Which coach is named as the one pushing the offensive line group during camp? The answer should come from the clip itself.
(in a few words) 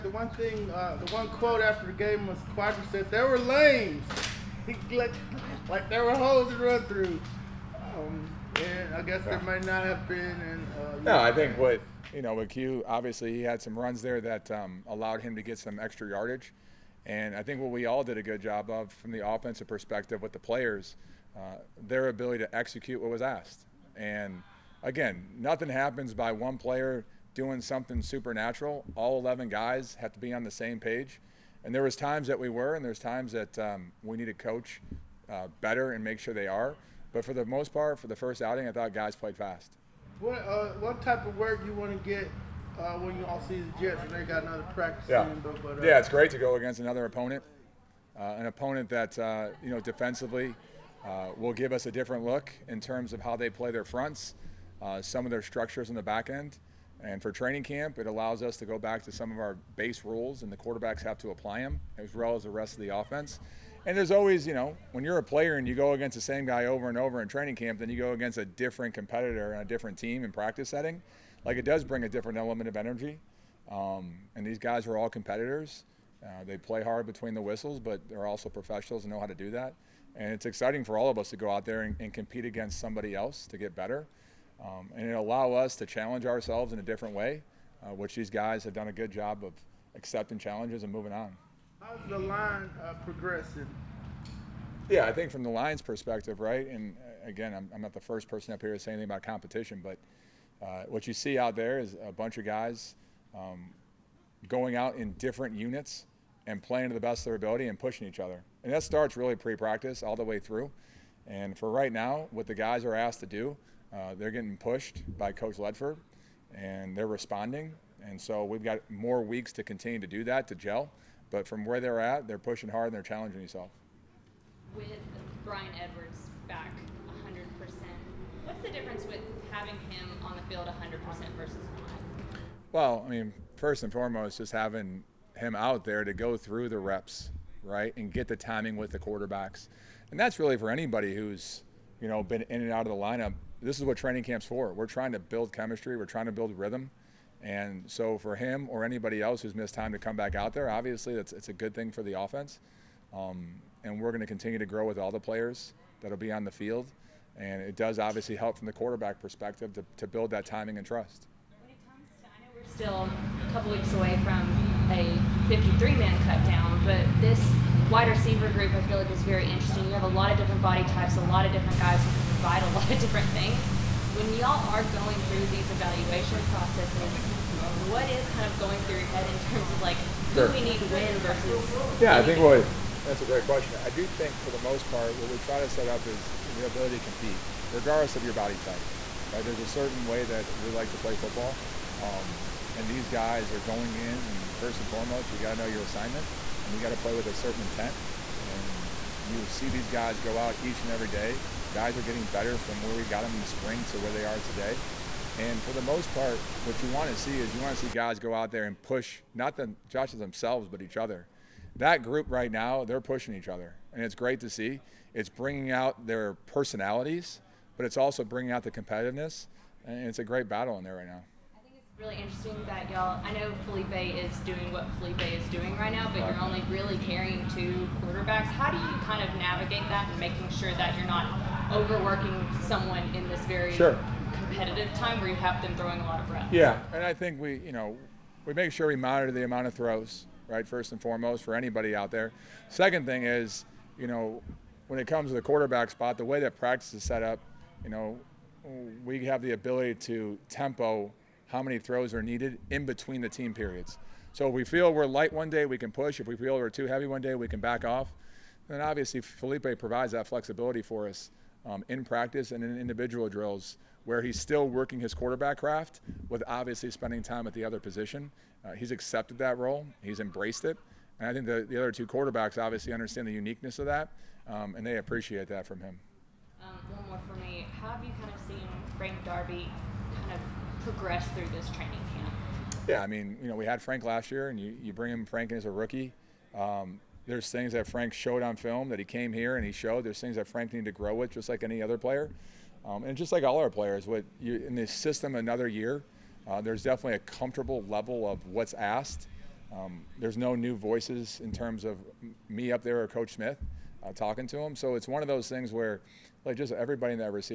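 Coach Ledford.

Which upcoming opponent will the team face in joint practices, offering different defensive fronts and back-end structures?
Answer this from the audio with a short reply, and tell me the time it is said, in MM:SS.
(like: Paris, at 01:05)
Jets, at 00:43.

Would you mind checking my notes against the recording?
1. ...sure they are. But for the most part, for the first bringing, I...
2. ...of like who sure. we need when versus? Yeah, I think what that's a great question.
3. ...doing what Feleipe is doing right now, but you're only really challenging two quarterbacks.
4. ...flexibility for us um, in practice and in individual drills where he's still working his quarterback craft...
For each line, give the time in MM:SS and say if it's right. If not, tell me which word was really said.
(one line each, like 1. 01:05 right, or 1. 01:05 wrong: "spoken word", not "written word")
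1. 00:36 wrong: "outing", not "bringing"
2. 02:59 right
3. 03:44 wrong: "carrying", not "challenging"
4. 04:20 right.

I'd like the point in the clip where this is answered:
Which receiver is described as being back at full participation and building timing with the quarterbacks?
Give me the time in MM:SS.
02:05.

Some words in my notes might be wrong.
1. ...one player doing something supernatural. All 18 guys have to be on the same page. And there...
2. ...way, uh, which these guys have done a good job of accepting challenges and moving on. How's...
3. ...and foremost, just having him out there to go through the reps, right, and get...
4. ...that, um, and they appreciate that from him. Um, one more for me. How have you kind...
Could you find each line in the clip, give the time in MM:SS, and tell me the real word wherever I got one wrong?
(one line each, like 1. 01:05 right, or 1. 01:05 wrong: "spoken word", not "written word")
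1. 00:26 wrong: "11", not "18"
2. 01:27 right
3. 02:13 right
4. 04:33 right.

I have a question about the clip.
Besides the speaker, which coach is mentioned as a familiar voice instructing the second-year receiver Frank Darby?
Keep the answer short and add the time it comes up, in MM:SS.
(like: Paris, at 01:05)
Coach Smith, at 05:03.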